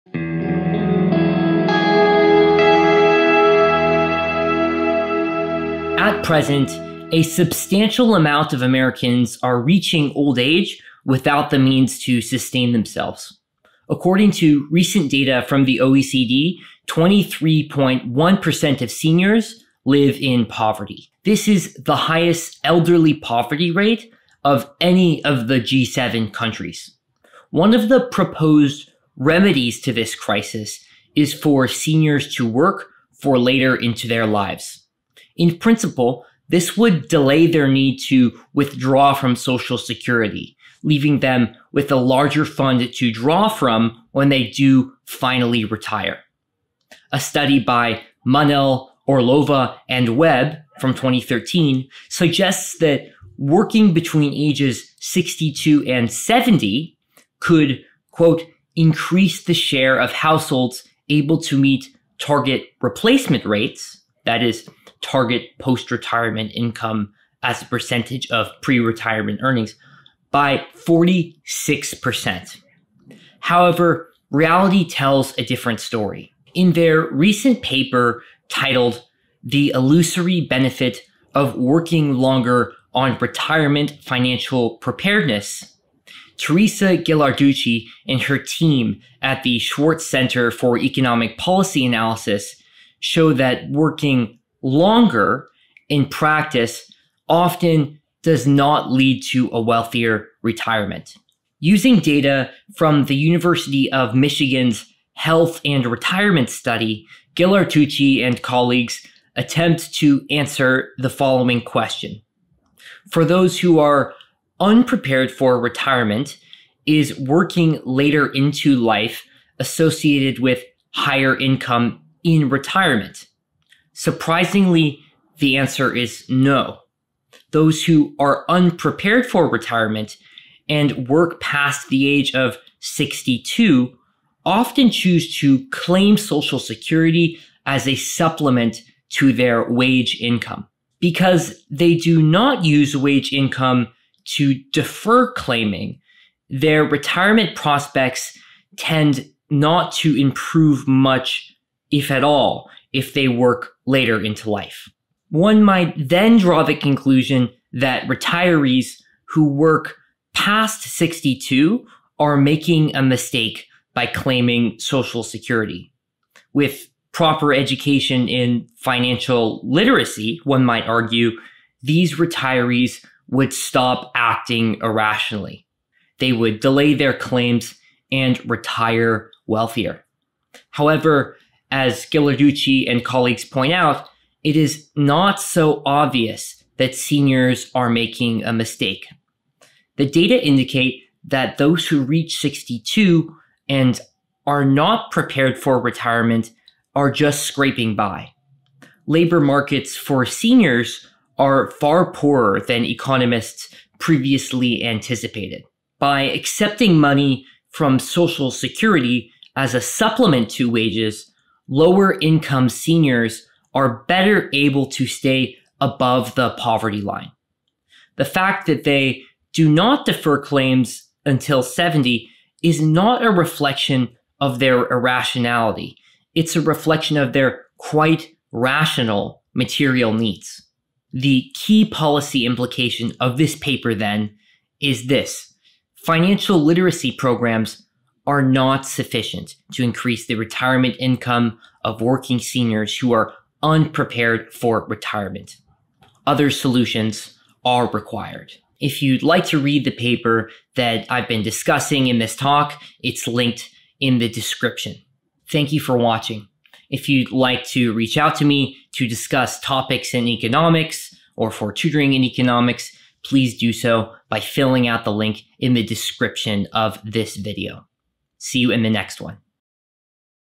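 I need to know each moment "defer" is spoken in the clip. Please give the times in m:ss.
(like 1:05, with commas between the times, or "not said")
2:24, 3:40.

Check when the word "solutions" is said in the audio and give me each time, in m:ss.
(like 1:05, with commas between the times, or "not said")
4:06.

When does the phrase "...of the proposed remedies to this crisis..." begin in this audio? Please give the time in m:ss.
0:27.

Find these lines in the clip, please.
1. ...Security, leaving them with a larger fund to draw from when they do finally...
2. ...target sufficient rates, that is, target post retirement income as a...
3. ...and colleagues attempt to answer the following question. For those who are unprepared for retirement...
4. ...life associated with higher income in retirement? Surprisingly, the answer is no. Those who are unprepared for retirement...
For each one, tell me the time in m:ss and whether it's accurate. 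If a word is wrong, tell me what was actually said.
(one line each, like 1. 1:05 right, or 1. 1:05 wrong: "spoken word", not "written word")
1. 0:39 right
2. 1:02 wrong: "replacement", not "sufficient"
3. 1:48 right
4. 1:58 right.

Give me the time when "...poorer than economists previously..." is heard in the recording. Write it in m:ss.
3:22.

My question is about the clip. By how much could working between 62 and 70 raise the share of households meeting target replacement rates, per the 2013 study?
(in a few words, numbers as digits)
46%.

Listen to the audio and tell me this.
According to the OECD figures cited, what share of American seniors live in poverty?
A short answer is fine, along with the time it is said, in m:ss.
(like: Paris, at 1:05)
23.1%, at 0:16.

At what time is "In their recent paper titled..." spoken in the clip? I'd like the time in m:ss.
1:16.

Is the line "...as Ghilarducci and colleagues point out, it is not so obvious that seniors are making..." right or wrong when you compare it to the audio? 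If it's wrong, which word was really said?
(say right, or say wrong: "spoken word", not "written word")
right.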